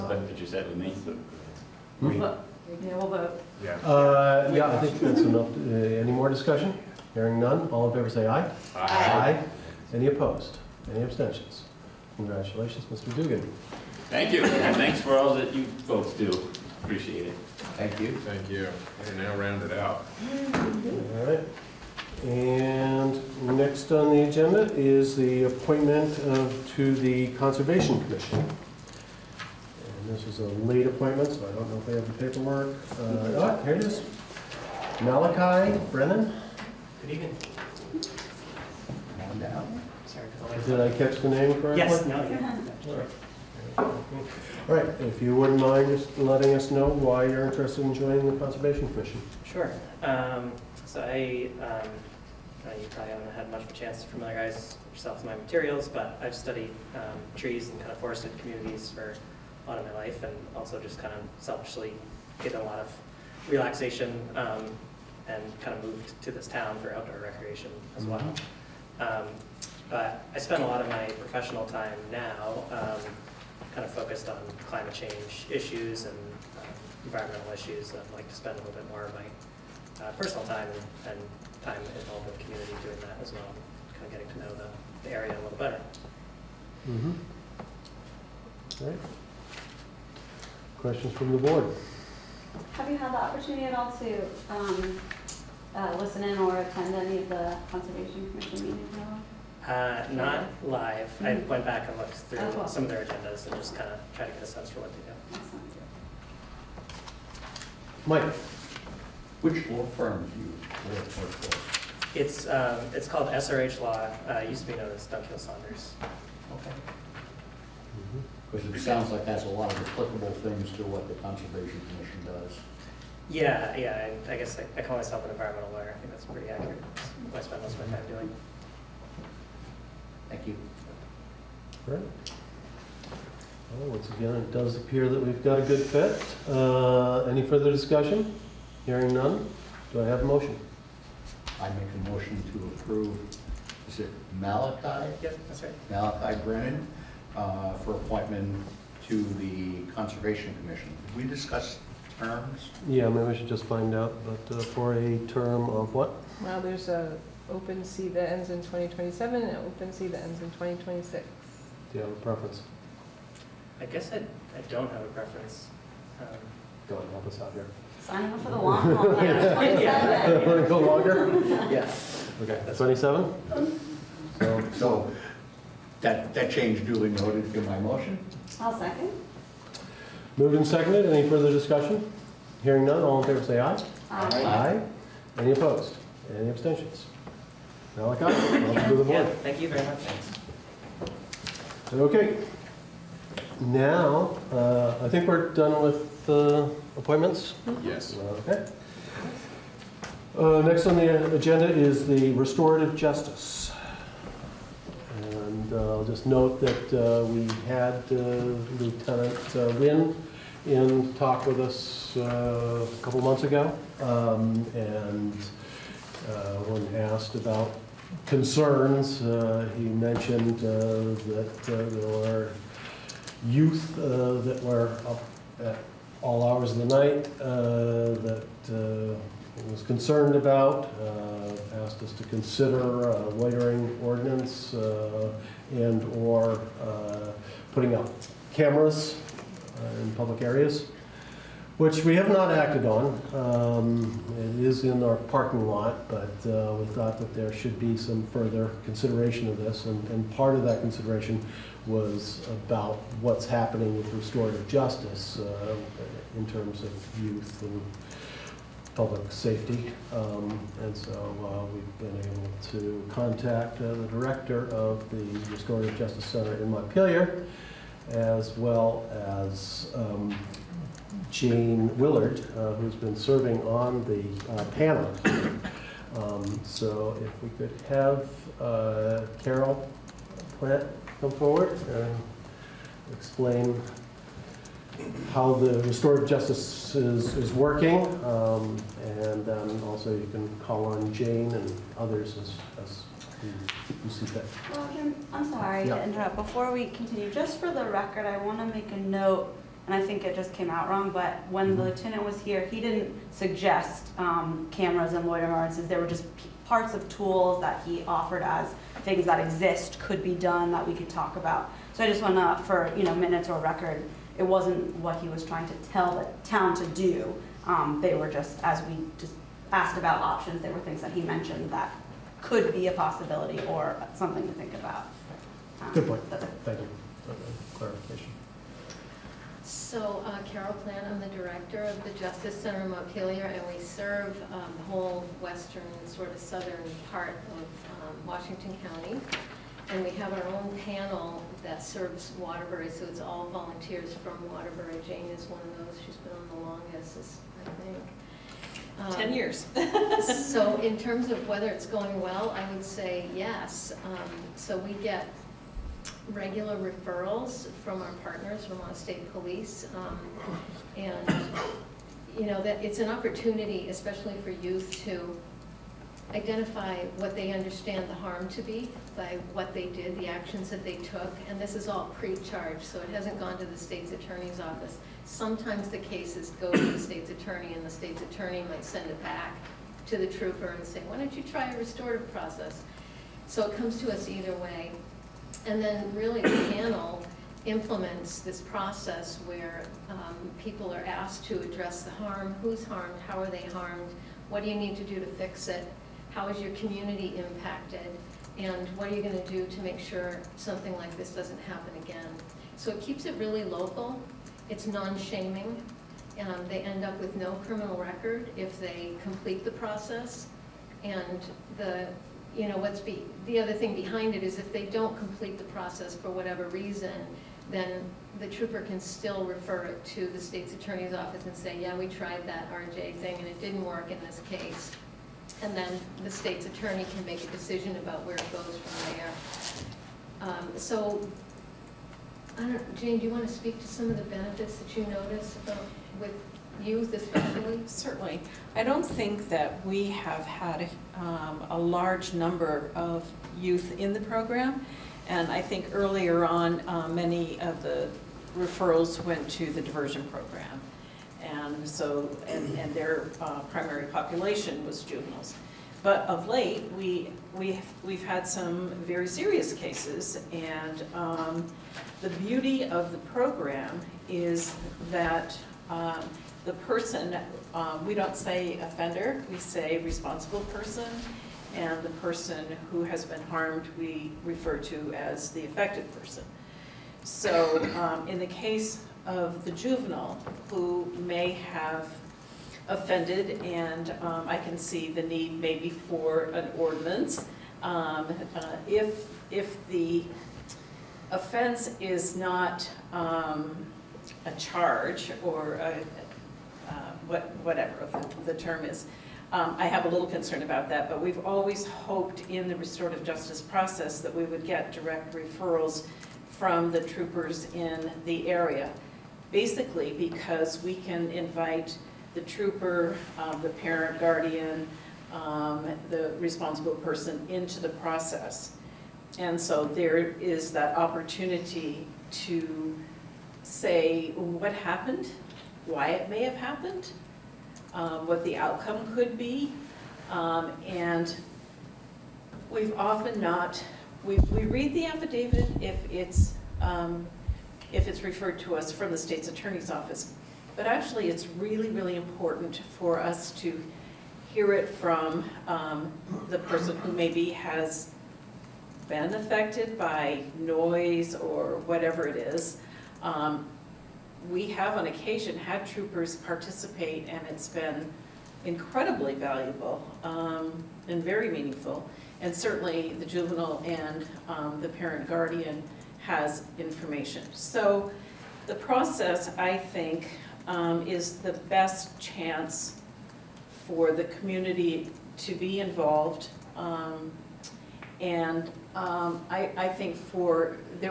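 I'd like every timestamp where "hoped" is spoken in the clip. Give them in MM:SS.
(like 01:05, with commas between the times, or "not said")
08:21.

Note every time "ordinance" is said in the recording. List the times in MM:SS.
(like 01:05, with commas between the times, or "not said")
03:54, 05:05, 08:06.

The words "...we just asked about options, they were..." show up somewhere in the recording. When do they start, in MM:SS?
05:18.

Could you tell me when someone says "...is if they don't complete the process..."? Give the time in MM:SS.
06:54.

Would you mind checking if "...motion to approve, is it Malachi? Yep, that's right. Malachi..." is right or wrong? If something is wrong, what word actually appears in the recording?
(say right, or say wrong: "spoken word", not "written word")
right.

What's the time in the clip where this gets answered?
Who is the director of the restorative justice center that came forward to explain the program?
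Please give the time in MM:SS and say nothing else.
04:39.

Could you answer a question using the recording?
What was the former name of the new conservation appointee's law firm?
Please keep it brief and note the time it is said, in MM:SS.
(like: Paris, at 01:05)
Duncan Saunders, at 01:55.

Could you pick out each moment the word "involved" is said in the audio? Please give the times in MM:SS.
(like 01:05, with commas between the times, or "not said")
01:22, 09:35.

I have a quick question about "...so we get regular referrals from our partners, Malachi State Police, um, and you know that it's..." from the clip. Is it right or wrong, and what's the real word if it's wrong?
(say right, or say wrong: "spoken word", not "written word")
wrong: "Vermont", not "Malachi".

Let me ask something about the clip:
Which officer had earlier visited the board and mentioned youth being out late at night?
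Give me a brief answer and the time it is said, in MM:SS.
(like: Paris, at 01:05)
Lieutenant Wynn, at 03:28.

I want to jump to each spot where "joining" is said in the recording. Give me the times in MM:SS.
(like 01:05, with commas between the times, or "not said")
00:47.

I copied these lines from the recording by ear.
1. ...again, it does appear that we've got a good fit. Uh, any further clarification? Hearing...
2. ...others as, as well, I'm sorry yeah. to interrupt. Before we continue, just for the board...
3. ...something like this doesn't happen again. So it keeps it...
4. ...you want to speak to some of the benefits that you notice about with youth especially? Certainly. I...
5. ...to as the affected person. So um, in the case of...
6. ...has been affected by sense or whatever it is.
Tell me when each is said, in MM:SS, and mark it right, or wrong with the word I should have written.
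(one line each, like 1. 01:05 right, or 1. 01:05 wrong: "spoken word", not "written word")
1. 02:14 wrong: "discussion", not "clarification"
2. 04:51 wrong: "record", not "board"
3. 06:40 right
4. 07:13 right
5. 07:54 right
6. 09:07 wrong: "noise", not "sense".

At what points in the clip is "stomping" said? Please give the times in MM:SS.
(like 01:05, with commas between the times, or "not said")
not said.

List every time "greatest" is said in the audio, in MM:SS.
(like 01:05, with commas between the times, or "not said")
not said.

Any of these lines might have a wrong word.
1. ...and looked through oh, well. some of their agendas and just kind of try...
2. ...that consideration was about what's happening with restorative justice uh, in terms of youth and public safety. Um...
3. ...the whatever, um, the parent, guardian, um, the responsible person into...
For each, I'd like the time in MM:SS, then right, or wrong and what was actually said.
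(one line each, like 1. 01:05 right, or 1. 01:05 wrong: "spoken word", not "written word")
1. 01:41 right
2. 04:10 right
3. 08:32 wrong: "trooper", not "whatever".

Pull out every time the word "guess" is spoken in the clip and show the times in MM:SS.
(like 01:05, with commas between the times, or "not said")
02:04, 02:43.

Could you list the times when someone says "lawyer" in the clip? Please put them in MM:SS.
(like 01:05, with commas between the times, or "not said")
02:05, 05:05.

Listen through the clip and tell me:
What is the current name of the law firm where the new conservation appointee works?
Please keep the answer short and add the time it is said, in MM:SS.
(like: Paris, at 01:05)
SRH Law, at 01:53.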